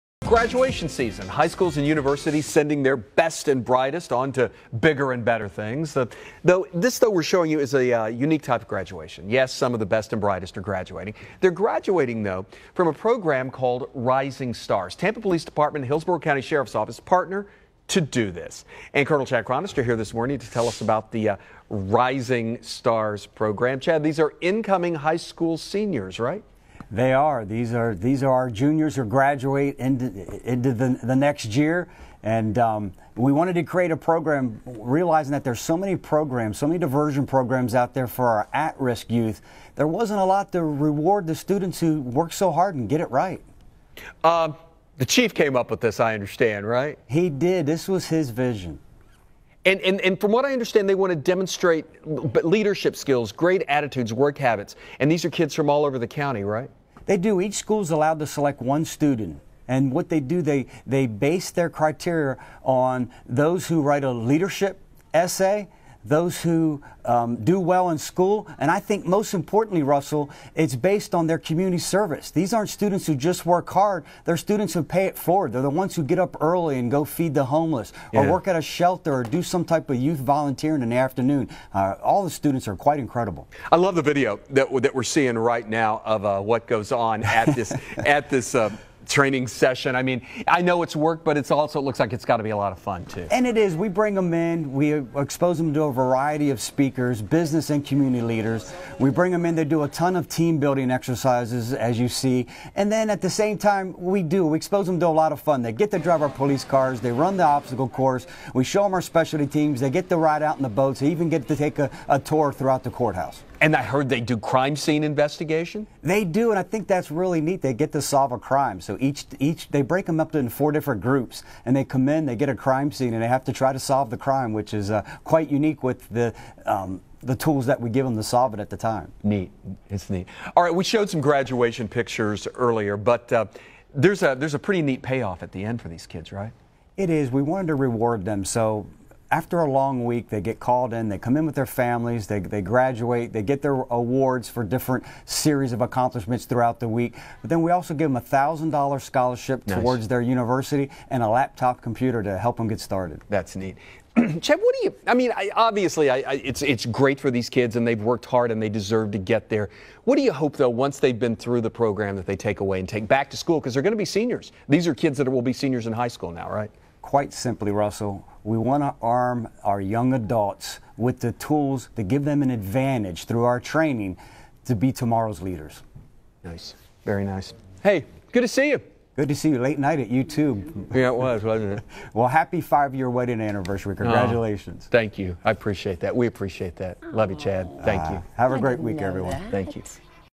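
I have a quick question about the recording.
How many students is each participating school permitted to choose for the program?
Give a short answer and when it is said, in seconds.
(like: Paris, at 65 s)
1, at 58 s.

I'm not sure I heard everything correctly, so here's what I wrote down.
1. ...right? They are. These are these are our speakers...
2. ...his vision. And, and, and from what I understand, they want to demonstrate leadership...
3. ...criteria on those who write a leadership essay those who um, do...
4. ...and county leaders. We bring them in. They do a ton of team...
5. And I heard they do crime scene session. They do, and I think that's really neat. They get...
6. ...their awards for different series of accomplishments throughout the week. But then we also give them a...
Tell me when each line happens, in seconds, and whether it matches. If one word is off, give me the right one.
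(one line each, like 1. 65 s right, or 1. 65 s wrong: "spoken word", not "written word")
1. 26 s wrong: "juniors", not "speakers"
2. 48 s right
3. 61 s right
4. 97 s wrong: "community", not "county"
5. 113 s wrong: "investigation", not "session"
6. 143 s right.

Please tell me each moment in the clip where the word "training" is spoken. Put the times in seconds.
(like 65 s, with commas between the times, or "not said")
89 s, 173 s.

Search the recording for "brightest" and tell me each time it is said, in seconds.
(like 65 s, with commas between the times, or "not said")
3 s, 10 s.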